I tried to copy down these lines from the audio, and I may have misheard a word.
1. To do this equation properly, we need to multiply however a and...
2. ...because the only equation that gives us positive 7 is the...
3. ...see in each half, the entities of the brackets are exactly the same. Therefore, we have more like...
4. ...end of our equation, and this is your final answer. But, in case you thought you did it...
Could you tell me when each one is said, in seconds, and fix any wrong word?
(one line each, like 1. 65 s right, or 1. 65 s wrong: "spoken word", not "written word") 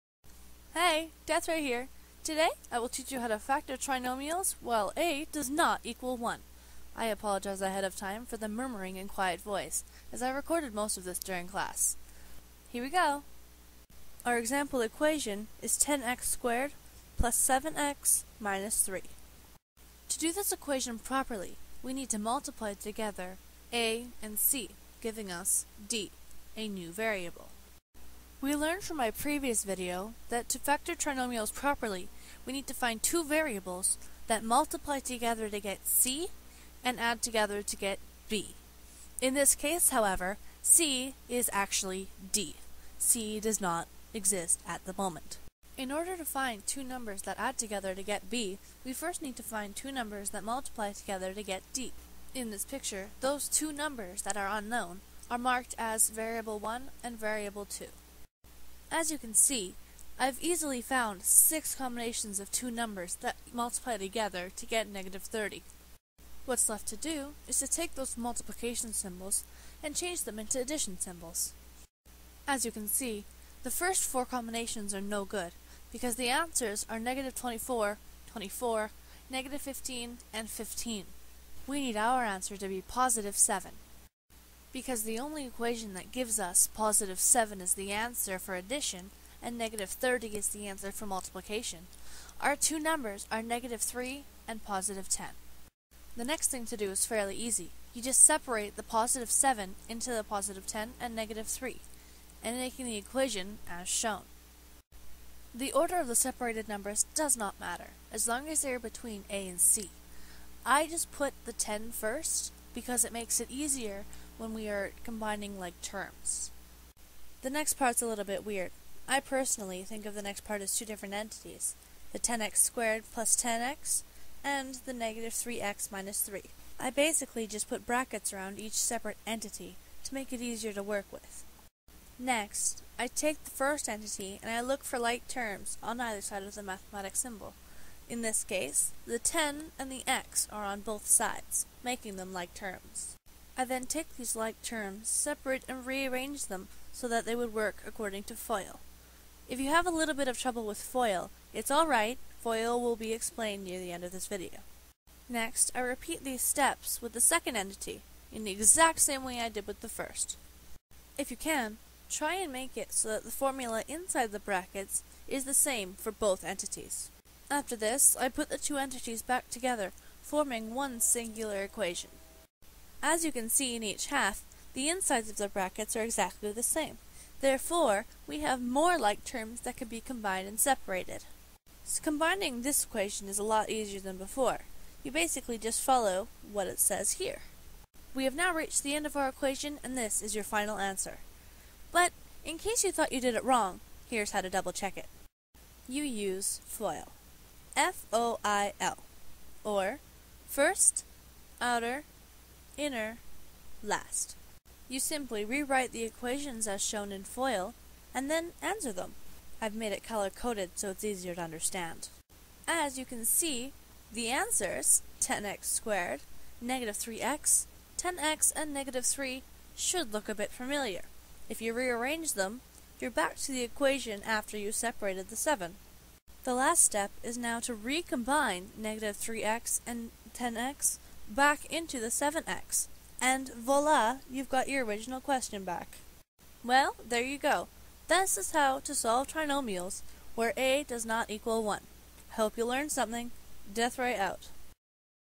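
1. 20 s wrong: "together", not "however"
2. 84 s right
3. 173 s wrong: "insides", not "entities"
4. 188 s right.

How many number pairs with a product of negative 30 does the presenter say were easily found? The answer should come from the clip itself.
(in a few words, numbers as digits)
6.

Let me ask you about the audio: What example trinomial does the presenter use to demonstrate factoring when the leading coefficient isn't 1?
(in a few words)
10x^2 + 7x - 3.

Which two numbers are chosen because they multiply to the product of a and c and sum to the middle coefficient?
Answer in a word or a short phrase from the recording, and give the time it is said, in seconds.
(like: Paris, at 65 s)
-3 and 10, at 93 s.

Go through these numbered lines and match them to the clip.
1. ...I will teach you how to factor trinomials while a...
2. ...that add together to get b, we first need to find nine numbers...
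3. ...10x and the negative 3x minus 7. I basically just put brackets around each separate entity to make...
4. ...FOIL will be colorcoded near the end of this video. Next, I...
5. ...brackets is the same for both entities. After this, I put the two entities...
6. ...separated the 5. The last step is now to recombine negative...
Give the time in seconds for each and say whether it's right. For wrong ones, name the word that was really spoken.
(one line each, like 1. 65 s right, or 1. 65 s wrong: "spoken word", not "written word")
1. 2 s right
2. 47 s wrong: "two", not "nine"
3. 123 s wrong: "3", not "7"
4. 152 s wrong: "explained", not "colorcoded"
5. 164 s right
6. 224 s wrong: "7", not "5".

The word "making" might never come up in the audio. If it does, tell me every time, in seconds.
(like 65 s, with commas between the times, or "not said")
102 s, 141 s.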